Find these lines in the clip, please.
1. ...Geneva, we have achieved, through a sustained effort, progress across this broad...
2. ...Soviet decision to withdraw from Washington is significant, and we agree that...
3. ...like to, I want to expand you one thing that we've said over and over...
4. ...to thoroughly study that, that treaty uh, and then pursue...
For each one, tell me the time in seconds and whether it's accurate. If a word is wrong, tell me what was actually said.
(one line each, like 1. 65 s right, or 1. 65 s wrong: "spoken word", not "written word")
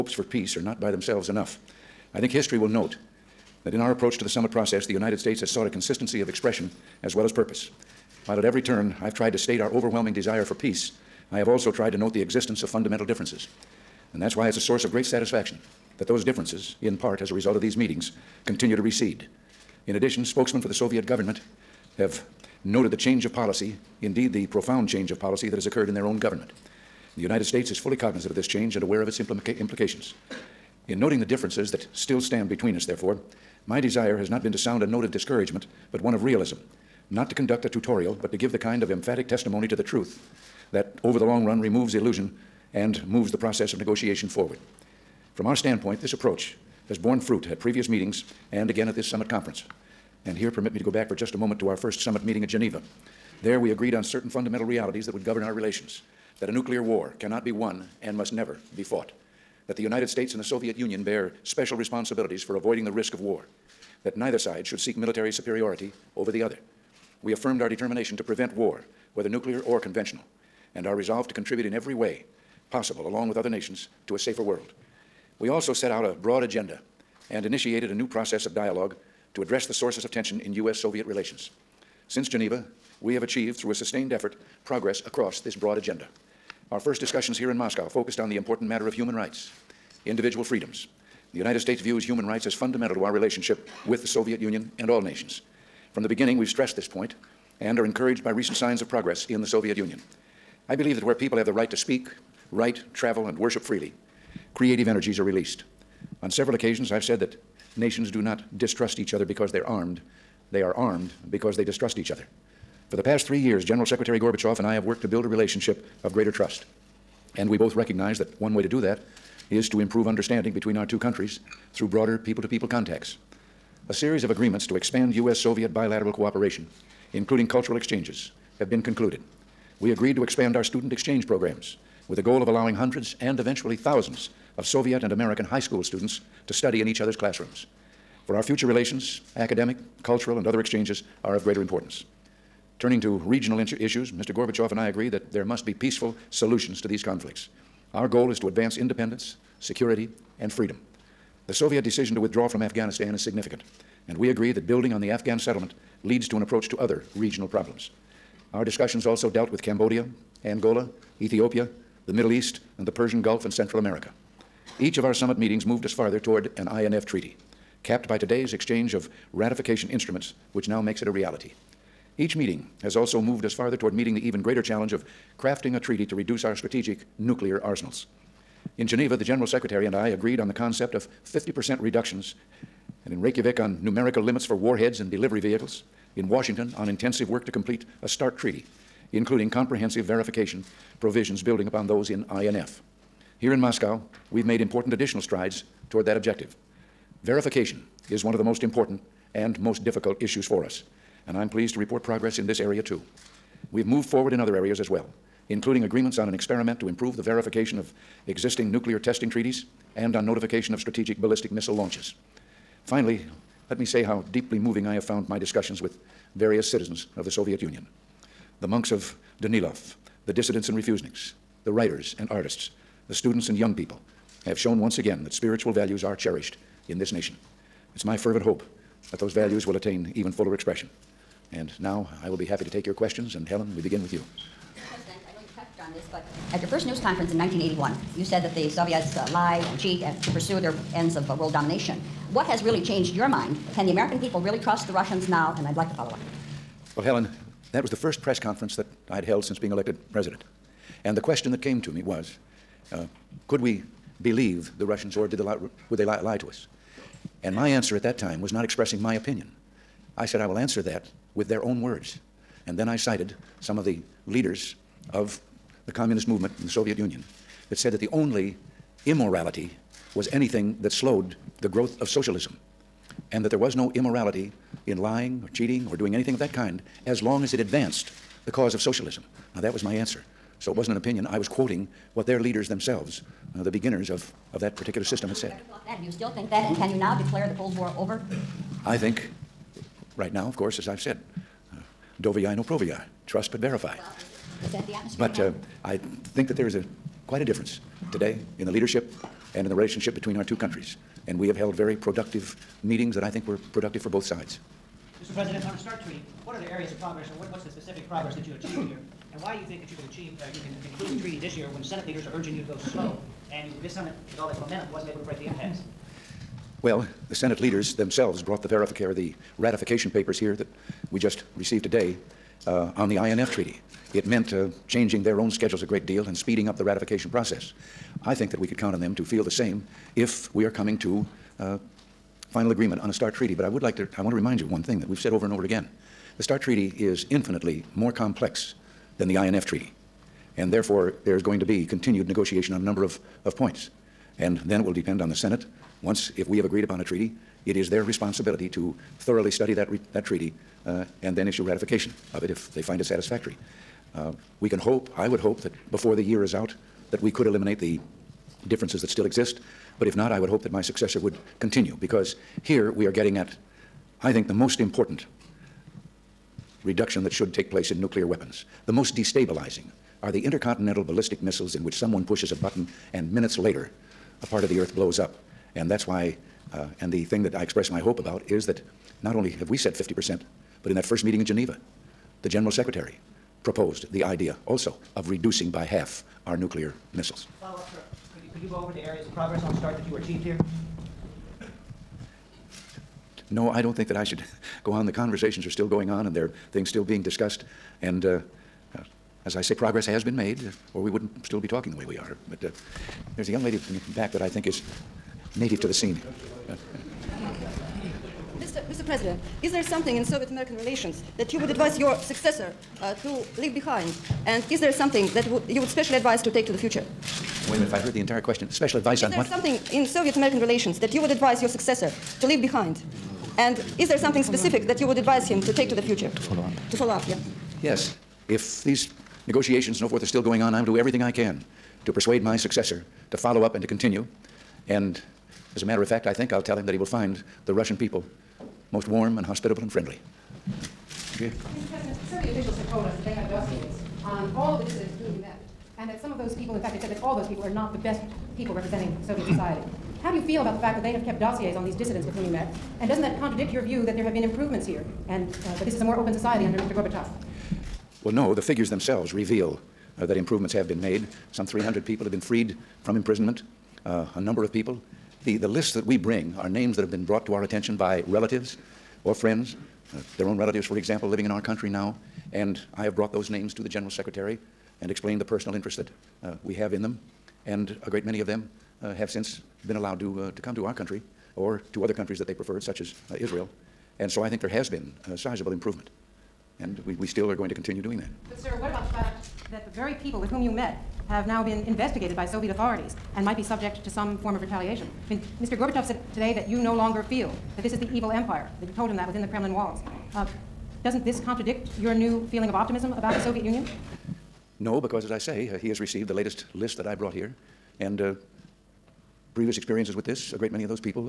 1. 82 s right
2. 151 s wrong: "Afghanistan", not "Washington"
3. 333 s wrong: "remind", not "expand"
4. 348 s wrong: "issue", not "pursue".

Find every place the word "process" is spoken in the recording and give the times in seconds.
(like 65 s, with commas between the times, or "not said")
4 s, 43 s, 78 s, 327 s.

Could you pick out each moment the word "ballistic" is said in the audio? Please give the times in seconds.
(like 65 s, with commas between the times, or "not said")
211 s, 371 s.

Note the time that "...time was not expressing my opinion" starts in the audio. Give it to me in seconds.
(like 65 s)
258 s.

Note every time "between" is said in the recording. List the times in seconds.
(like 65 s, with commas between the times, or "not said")
32 s, 120 s, 300 s.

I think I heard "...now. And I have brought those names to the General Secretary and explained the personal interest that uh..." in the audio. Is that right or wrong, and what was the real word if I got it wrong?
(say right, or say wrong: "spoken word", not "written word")
right.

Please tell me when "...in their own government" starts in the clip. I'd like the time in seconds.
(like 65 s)
25 s.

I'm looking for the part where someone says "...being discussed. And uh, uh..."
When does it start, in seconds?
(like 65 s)
397 s.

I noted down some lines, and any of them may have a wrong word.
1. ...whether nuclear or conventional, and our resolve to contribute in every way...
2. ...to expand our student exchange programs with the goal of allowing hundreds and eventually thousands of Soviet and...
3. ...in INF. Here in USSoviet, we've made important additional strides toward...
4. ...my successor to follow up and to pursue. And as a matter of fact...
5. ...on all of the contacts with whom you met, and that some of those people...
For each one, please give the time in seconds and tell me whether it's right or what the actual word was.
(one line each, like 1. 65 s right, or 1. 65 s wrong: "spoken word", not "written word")
1. 69 s right
2. 130 s right
3. 192 s wrong: "Moscow", not "USSoviet"
4. 432 s wrong: "continue", not "pursue"
5. 444 s wrong: "dissidents", not "contacts".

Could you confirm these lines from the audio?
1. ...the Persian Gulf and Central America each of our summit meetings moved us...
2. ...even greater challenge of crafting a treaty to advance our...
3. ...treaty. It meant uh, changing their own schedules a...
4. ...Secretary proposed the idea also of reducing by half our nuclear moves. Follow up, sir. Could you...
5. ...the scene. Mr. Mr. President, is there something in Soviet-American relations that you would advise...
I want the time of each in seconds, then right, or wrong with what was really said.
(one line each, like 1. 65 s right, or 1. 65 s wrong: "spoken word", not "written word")
1. 162 s right
2. 174 s wrong: "reduce", not "advance"
3. 323 s right
4. 382 s wrong: "missiles", not "moves"
5. 405 s right.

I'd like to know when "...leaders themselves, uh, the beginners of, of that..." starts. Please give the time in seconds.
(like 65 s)
282 s.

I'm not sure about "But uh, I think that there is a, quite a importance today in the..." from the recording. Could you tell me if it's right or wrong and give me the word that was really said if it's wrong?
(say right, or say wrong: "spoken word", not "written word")
wrong: "difference", not "importance".